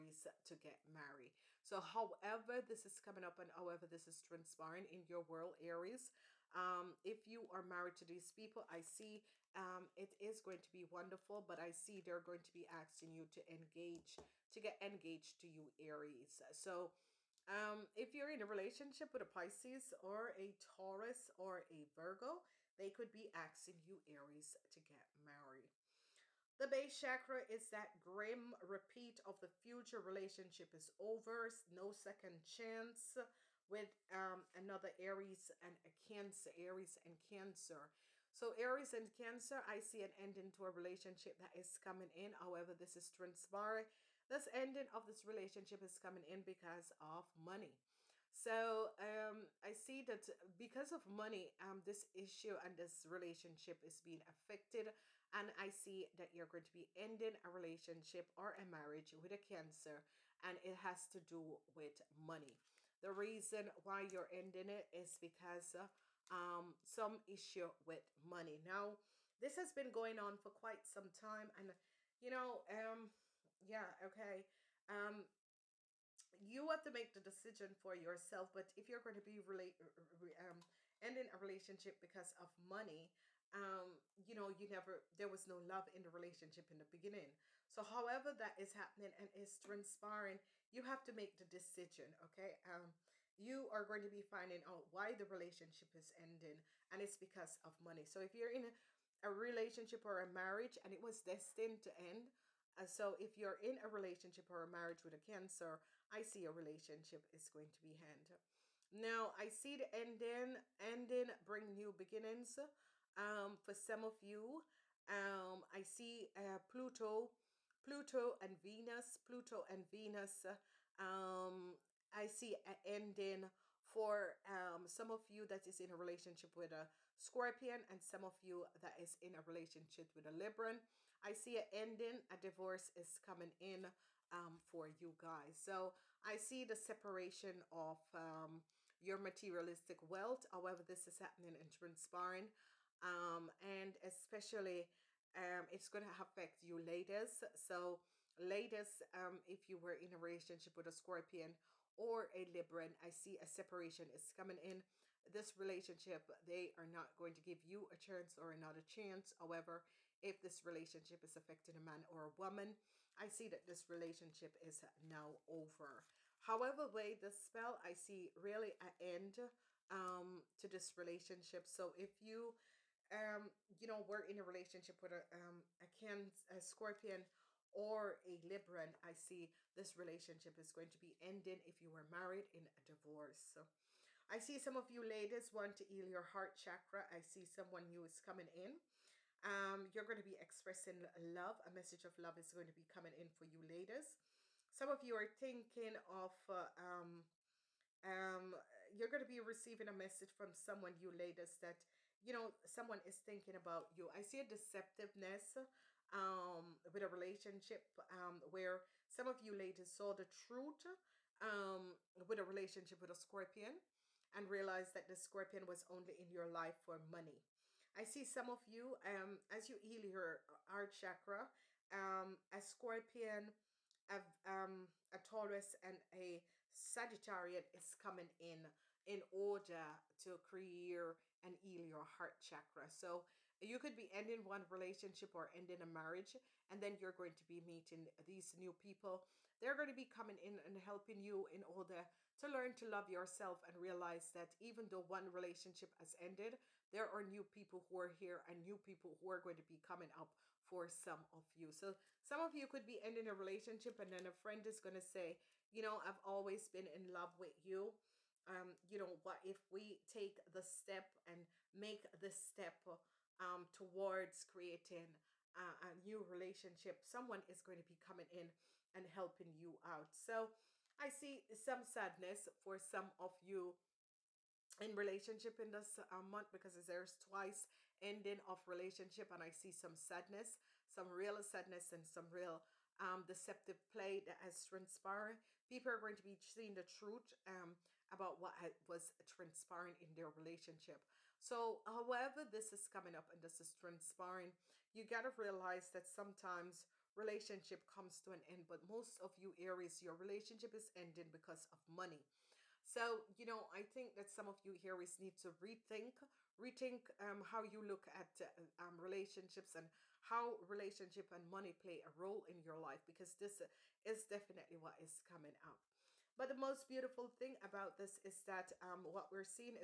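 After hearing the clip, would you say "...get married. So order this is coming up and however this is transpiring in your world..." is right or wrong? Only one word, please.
wrong.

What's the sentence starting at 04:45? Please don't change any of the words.
People are going to be seeing the truth um, about what was transpiring in their relationship.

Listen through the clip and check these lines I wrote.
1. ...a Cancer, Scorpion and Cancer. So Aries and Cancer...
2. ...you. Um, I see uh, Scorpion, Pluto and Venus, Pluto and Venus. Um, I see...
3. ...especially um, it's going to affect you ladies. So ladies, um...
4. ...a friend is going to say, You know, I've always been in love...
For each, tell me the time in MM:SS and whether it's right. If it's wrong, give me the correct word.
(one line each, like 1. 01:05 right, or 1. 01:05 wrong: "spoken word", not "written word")
1. 00:35 wrong: "Aries", not "Scorpion"
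2. 01:54 wrong: "Pluto", not "Scorpion"
3. 02:24 right
4. 04:14 right.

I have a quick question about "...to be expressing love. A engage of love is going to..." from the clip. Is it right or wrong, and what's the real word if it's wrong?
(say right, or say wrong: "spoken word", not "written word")
wrong: "message", not "engage".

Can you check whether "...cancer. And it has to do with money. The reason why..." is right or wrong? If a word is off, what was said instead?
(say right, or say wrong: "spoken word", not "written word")
right.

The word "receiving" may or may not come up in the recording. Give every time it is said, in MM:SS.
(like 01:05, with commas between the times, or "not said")
03:19.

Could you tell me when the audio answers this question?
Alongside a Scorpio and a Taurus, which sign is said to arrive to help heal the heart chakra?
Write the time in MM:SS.
03:46.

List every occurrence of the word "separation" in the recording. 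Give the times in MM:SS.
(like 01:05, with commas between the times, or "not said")
02:16, 02:33.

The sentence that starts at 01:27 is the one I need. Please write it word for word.
So, however, that is happening and is transpiring, you have to make the decision, okay?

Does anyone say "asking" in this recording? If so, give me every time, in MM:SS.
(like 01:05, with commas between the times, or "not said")
00:12, 00:23.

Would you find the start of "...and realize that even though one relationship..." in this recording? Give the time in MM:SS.
04:03.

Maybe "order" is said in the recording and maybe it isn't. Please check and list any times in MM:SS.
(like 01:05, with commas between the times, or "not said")
03:49, 04:01.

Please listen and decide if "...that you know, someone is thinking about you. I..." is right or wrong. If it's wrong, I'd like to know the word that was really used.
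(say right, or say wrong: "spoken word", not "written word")
right.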